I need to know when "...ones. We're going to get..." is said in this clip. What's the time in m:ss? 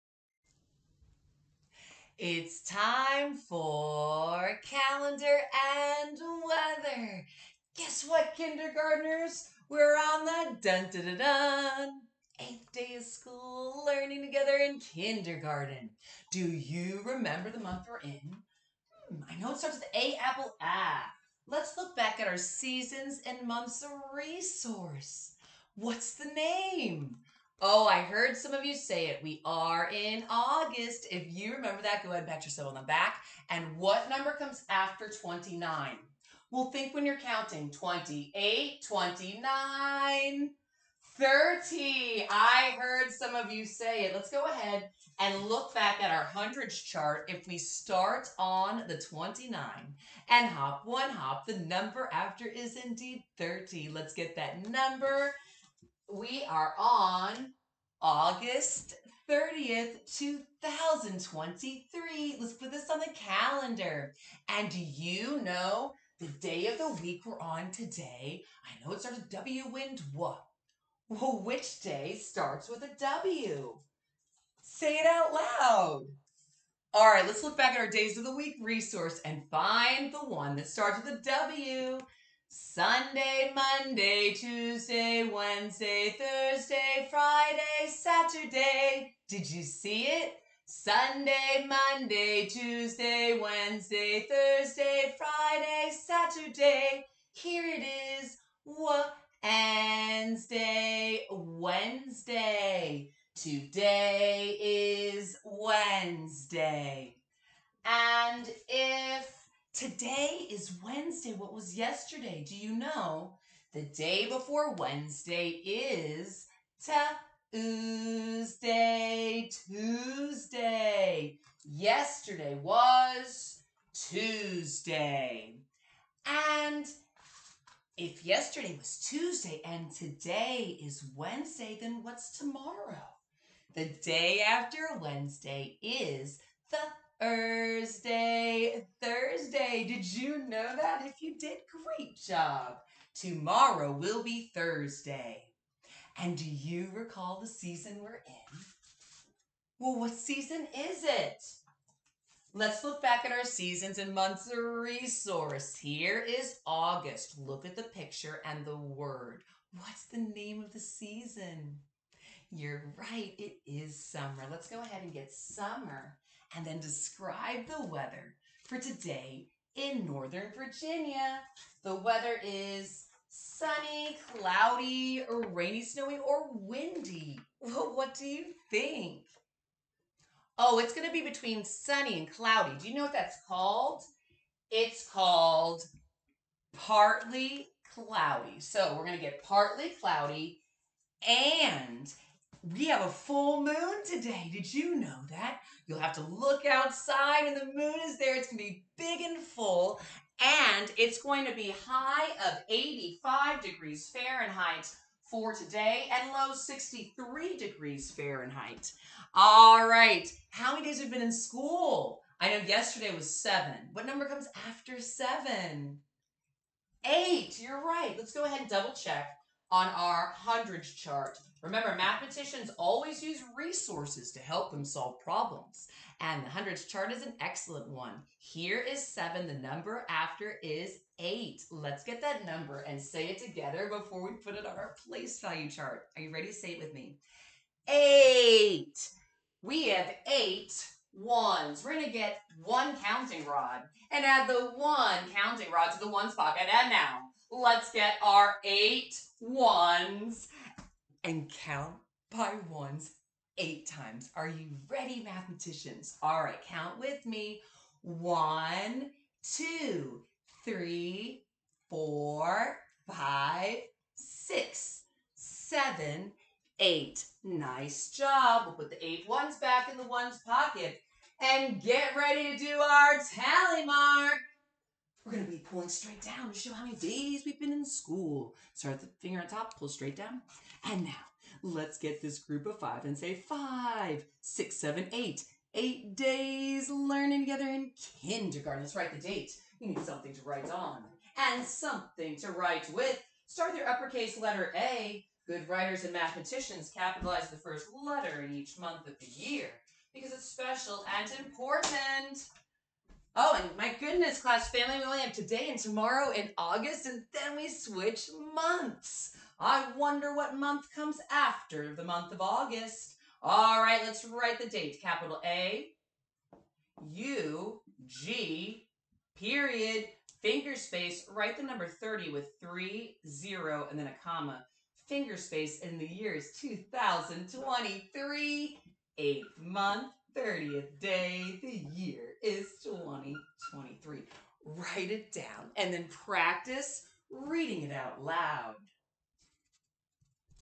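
4:01.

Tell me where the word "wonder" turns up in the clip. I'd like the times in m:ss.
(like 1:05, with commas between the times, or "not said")
5:09.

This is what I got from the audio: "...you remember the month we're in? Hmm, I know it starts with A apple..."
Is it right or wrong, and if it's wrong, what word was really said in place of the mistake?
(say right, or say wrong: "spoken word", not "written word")
right.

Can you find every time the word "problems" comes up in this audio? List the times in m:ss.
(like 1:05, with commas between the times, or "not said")
3:45.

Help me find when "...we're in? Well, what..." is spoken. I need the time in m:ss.
2:28.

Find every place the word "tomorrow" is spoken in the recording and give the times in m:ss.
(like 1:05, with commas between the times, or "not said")
2:12, 2:23, 5:05.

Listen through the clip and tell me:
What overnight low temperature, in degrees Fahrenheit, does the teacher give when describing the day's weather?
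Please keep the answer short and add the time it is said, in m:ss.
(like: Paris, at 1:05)
63, at 3:26.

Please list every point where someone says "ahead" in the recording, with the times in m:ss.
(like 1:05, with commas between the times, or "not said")
0:32, 0:44, 2:44, 3:38.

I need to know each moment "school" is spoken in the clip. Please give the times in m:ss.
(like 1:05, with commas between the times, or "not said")
0:13, 3:31, 4:37.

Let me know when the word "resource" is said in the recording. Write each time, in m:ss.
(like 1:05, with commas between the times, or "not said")
0:24, 1:18, 2:34, 3:43.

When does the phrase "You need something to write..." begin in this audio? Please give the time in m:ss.
4:49.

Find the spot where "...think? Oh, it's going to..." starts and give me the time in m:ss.
2:58.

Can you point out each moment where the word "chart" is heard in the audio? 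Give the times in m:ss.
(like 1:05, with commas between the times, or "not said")
0:46, 3:40, 3:46, 3:55.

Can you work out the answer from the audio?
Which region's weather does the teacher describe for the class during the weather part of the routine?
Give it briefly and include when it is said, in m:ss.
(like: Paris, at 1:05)
Northern Virginia, at 2:50.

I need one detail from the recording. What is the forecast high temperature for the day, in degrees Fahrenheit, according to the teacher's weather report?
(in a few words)
85.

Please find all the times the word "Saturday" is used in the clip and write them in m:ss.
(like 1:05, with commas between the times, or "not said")
1:27, 1:35.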